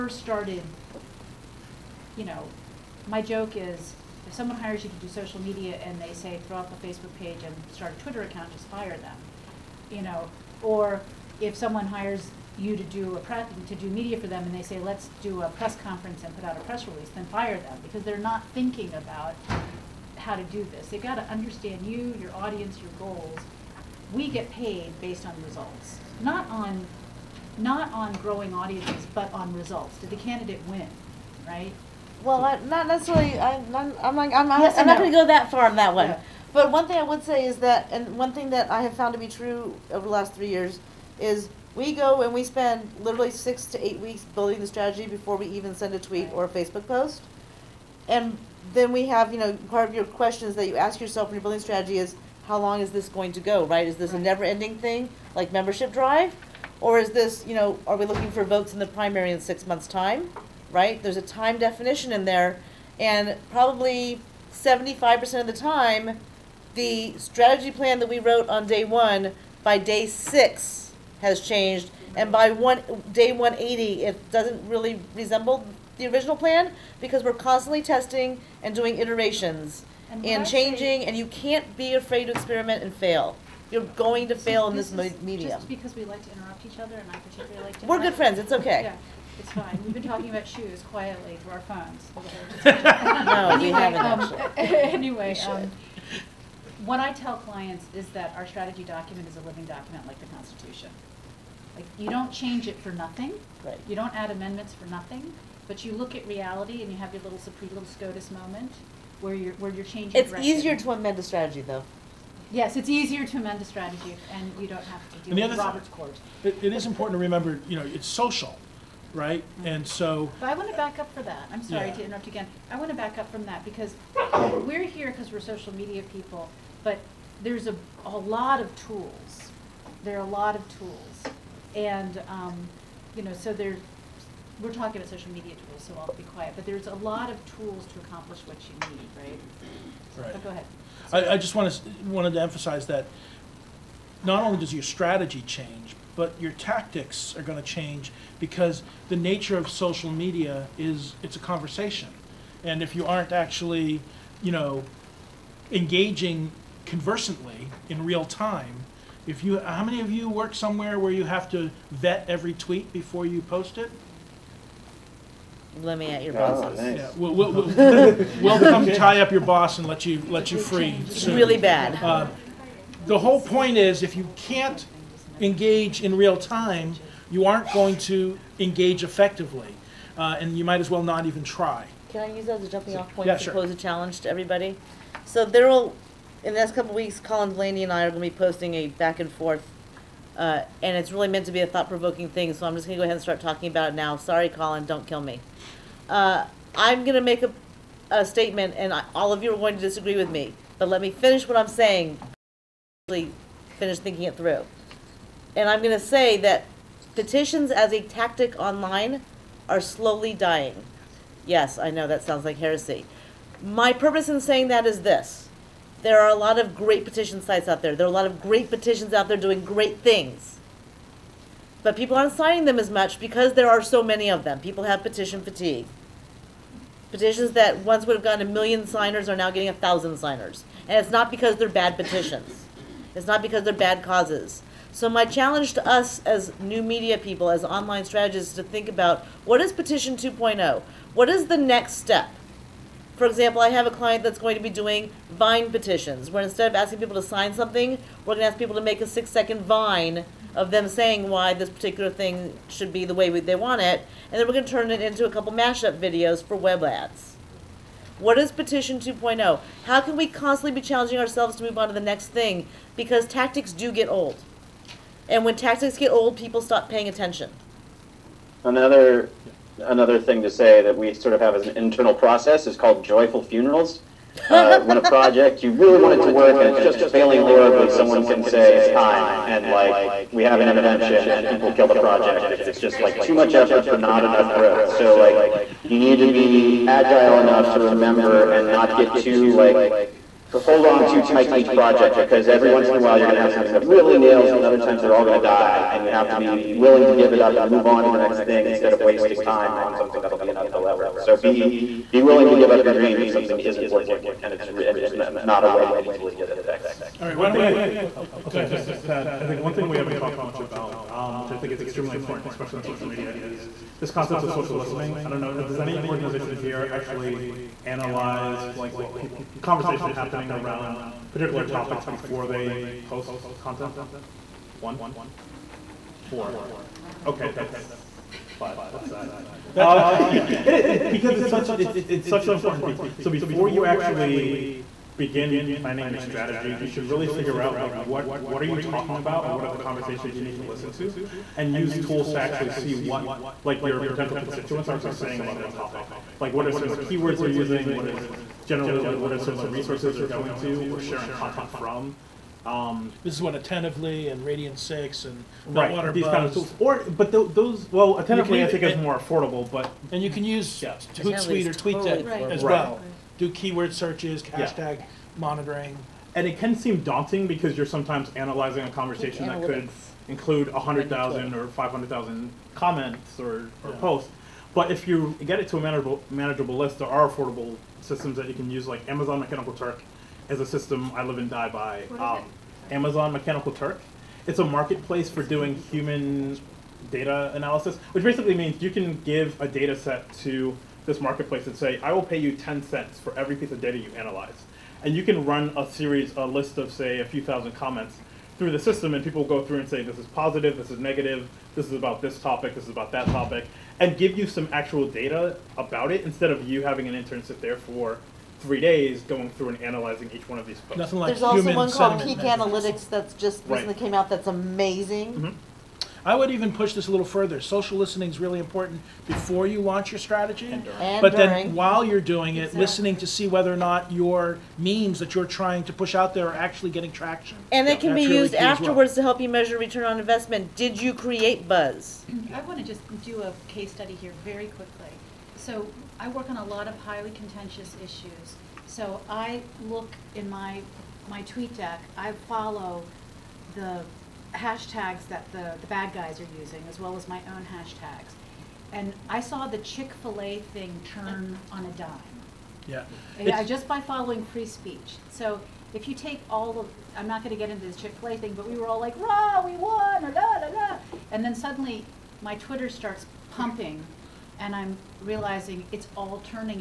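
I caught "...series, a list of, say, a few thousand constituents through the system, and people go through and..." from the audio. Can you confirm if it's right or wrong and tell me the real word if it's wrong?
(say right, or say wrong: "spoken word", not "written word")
wrong: "comments", not "constituents".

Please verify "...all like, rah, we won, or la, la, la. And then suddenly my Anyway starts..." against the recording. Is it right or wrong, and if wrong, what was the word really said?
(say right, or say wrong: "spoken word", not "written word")
wrong: "Twitter", not "Anyway".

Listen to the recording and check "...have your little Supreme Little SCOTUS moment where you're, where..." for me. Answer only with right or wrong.
right.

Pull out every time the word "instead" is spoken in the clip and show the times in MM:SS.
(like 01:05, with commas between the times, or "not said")
04:06, 04:58, 06:46.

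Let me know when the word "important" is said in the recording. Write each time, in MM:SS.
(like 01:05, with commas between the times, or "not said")
01:56, 05:12, 05:32, 06:58.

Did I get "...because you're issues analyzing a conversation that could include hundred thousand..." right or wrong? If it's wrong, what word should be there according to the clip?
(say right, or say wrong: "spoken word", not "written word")
wrong: "sometimes", not "issues".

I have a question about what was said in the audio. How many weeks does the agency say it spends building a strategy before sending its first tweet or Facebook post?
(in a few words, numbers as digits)
6 to 8 weeks.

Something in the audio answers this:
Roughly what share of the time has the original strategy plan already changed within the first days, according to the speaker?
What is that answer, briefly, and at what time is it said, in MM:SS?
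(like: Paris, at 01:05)
75%, at 01:04.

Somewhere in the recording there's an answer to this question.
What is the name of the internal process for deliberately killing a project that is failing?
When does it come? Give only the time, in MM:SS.
04:33.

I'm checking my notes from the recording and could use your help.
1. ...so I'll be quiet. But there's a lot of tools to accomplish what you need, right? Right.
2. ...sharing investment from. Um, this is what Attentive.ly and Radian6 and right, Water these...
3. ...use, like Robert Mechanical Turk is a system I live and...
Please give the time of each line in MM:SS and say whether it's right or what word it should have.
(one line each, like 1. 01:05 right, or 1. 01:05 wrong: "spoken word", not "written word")
1. 02:15 right
2. 05:50 wrong: "content", not "investment"
3. 06:18 wrong: "Amazon", not "Robert".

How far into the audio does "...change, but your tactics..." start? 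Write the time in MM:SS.
02:25.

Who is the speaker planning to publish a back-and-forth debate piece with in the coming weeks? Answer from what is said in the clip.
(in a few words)
Colin Delany.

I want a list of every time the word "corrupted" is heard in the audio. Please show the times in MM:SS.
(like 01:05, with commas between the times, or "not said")
not said.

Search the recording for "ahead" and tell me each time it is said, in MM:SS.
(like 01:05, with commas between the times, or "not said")
02:20, 03:13.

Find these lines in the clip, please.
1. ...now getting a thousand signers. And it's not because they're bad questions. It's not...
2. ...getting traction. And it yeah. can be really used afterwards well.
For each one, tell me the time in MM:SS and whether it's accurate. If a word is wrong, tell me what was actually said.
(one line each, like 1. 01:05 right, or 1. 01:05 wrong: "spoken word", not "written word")
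1. 03:49 wrong: "petitions", not "questions"
2. 07:06 right.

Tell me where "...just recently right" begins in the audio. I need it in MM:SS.
06:53.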